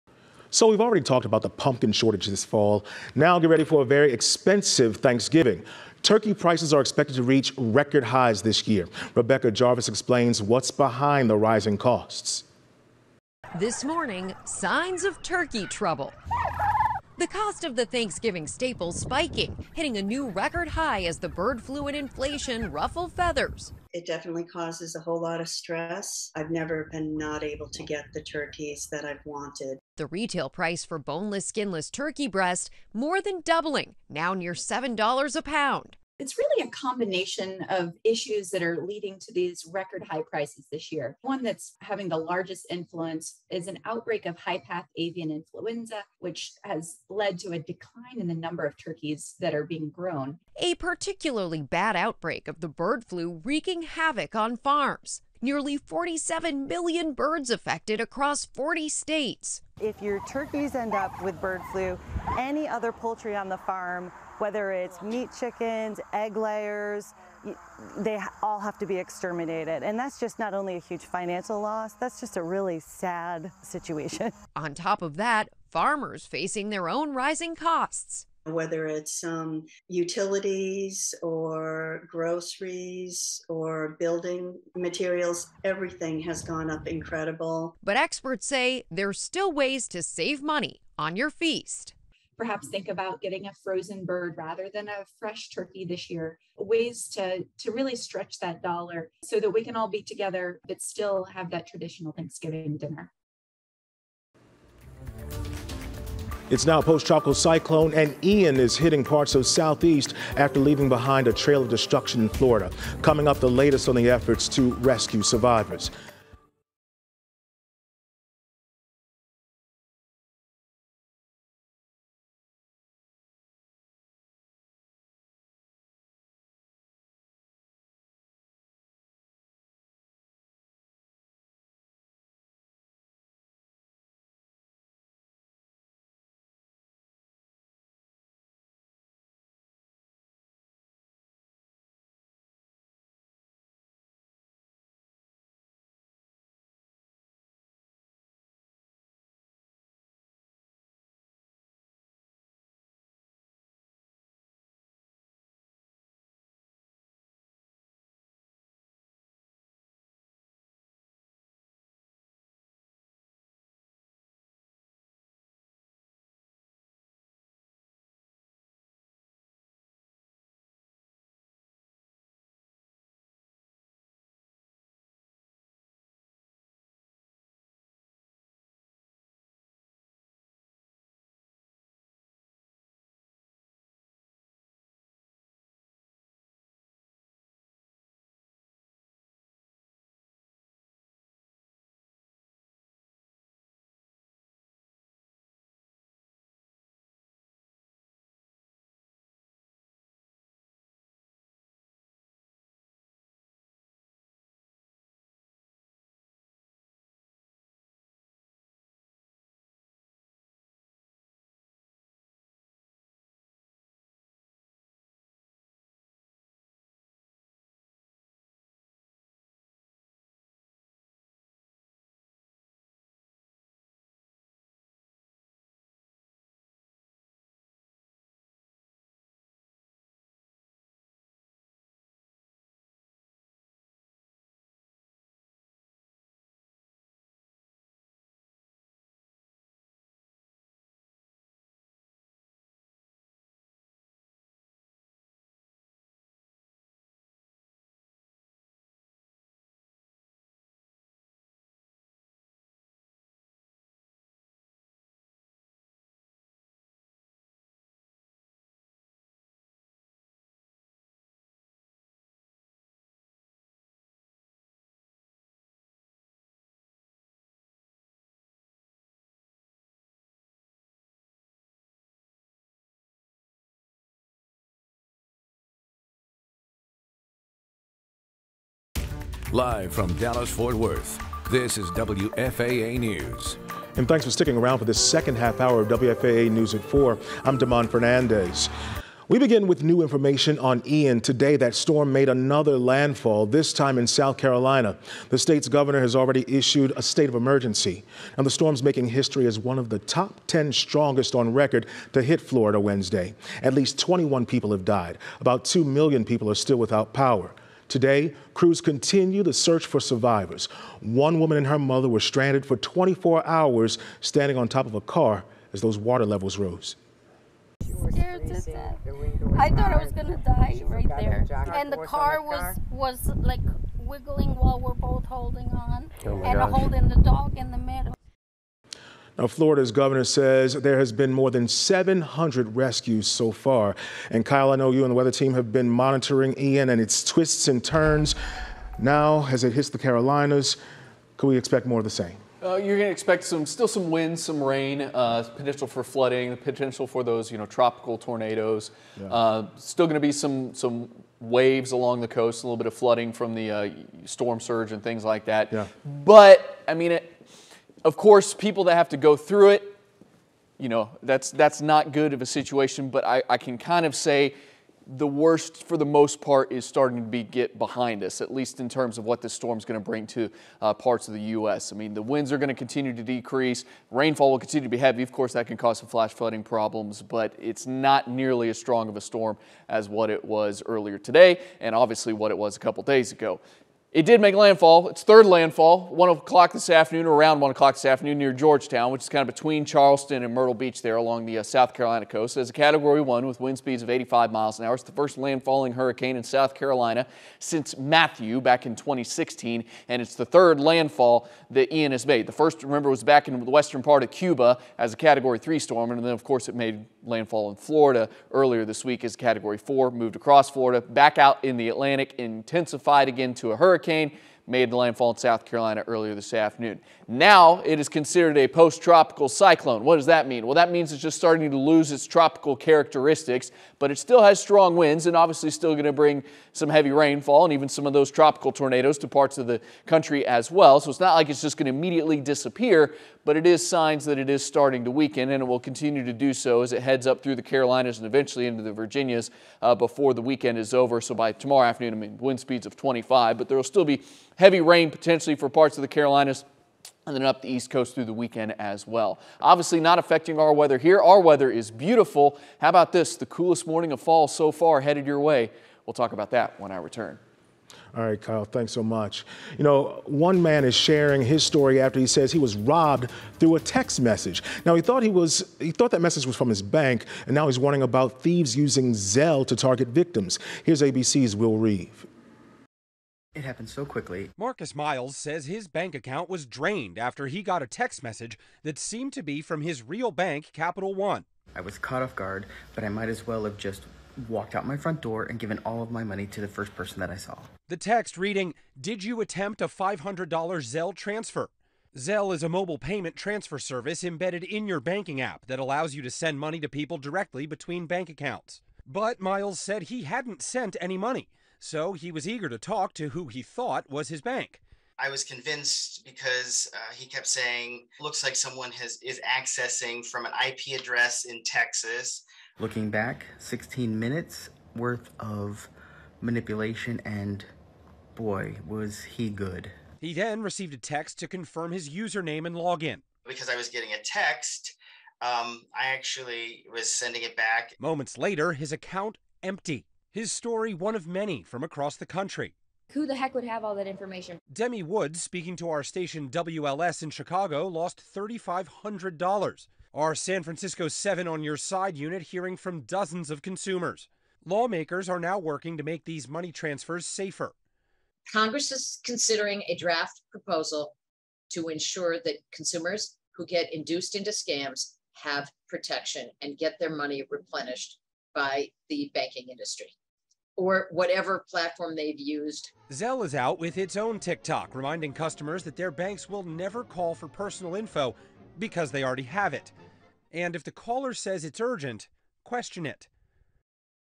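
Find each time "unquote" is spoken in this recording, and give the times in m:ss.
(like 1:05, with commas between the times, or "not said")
not said.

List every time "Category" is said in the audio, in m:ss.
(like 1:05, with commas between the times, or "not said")
6:32, 6:45, 6:49.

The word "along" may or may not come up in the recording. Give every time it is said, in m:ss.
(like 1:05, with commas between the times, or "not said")
5:51, 6:31.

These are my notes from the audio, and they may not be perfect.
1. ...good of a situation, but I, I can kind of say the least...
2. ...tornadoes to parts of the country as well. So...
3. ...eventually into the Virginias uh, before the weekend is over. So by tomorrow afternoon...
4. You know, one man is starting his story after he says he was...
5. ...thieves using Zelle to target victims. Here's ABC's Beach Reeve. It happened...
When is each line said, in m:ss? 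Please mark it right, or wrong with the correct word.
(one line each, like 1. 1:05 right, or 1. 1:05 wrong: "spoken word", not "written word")
1. 6:02 wrong: "worst", not "least"
2. 7:08 right
3. 7:18 right
4. 7:39 wrong: "sharing", not "starting"
5. 7:48 wrong: "Will", not "Beach".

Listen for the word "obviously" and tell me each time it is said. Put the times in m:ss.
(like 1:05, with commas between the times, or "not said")
6:21, 7:05, 7:29.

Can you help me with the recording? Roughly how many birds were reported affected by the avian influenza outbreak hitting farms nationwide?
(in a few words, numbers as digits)
47 million.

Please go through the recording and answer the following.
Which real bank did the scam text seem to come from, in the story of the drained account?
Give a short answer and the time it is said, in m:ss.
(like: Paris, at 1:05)
Capital One, at 8:00.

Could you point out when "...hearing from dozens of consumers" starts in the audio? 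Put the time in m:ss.
9:02.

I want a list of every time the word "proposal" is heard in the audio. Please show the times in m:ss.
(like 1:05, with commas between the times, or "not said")
9:10.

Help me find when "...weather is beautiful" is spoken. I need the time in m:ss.
7:31.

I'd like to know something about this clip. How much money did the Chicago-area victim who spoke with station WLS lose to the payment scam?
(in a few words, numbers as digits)
$3,500.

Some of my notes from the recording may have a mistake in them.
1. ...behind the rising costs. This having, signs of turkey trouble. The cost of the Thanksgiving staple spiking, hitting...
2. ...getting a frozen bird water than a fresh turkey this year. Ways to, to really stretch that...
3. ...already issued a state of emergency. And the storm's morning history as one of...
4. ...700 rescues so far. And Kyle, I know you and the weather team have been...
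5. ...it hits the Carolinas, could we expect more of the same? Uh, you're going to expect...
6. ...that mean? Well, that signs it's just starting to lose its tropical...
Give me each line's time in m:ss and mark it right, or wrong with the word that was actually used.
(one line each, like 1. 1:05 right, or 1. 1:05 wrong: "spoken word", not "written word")
1. 0:10 wrong: "morning", not "having"
2. 1:33 wrong: "rather", not "water"
3. 4:56 wrong: "making", not "morning"
4. 5:31 right
5. 5:39 right
6. 7:00 wrong: "means", not "signs".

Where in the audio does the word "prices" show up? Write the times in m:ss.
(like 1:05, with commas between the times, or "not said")
0:06, 0:30, 0:40.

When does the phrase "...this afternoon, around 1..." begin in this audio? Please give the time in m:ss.
6:26.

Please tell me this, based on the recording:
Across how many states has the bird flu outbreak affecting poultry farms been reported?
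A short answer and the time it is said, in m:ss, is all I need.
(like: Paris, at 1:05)
40, at 0:58.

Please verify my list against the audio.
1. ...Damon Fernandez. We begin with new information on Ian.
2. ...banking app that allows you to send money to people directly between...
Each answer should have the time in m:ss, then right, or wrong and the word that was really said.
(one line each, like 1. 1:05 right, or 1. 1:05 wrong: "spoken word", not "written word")
1. 4:47 right
2. 8:15 right.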